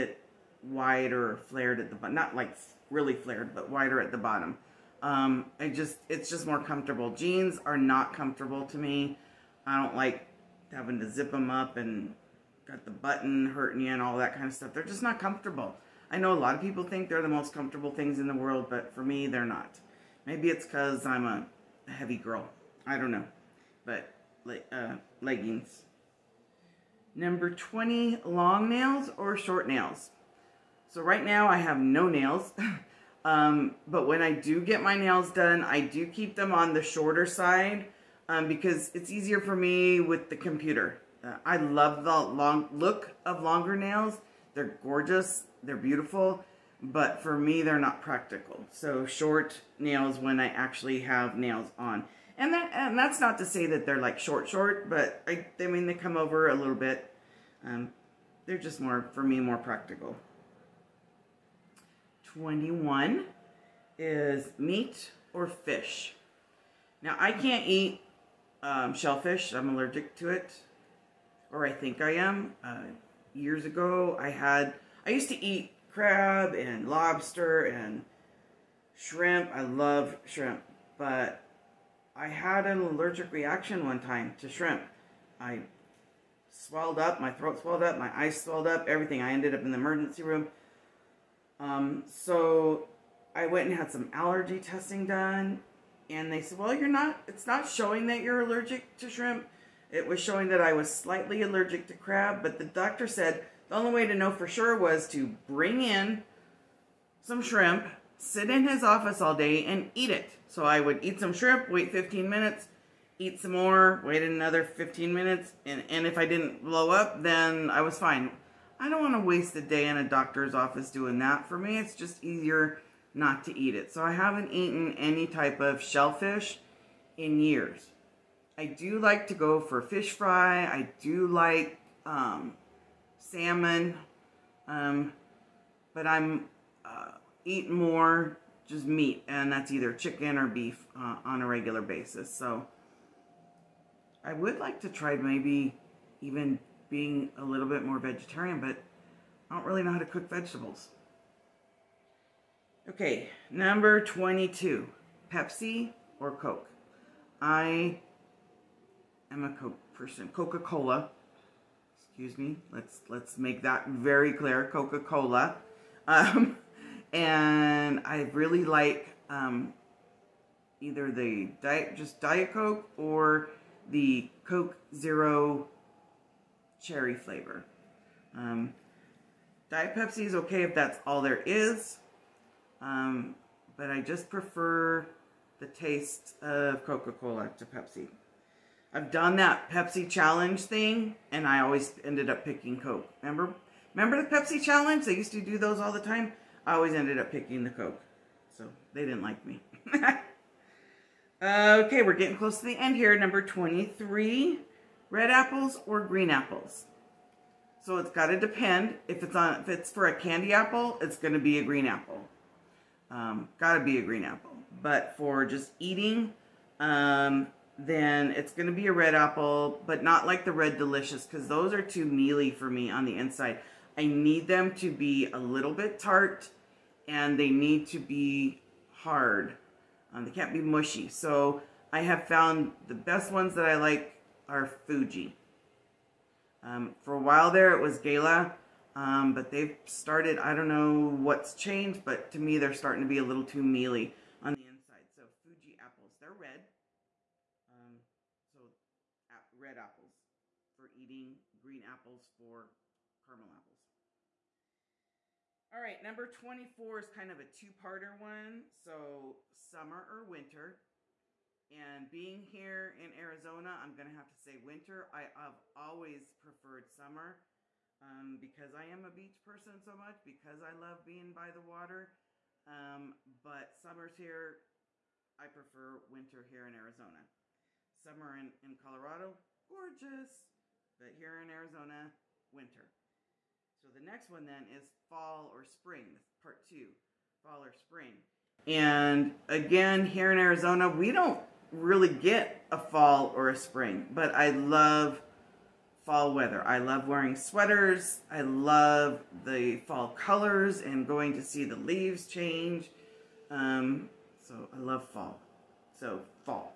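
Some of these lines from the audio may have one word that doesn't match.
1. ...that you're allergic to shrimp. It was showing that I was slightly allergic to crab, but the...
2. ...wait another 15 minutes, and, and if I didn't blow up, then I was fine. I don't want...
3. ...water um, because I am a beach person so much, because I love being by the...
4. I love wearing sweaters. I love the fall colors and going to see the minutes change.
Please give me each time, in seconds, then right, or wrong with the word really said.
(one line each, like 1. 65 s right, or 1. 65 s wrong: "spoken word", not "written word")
1. 98 s right
2. 114 s right
3. 266 s wrong: "summer", not "water"
4. 296 s wrong: "leaves", not "minutes".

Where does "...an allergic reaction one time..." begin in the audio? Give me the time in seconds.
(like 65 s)
82 s.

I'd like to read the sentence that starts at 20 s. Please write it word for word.
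Maybe it's because I'm a heavy girl.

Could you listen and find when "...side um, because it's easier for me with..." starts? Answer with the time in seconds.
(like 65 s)
37 s.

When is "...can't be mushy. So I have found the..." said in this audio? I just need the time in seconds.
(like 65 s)
230 s.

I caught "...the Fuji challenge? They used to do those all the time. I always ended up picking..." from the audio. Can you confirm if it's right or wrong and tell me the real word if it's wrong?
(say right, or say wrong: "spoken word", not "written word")
wrong: "Pepsi", not "Fuji".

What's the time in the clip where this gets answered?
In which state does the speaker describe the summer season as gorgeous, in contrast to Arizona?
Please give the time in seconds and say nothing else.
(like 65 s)
278 s.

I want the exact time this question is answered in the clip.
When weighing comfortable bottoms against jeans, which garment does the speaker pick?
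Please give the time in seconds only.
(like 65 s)
25 s.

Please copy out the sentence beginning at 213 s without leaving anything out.
Um, got to be a green apple.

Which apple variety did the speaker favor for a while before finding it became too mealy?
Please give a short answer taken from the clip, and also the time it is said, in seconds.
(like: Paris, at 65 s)
Gala, at 237 s.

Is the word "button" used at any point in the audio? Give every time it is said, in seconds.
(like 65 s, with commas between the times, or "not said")
12 s.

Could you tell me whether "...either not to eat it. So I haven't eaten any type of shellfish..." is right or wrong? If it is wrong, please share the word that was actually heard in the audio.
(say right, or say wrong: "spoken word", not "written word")
wrong: "easier", not "either".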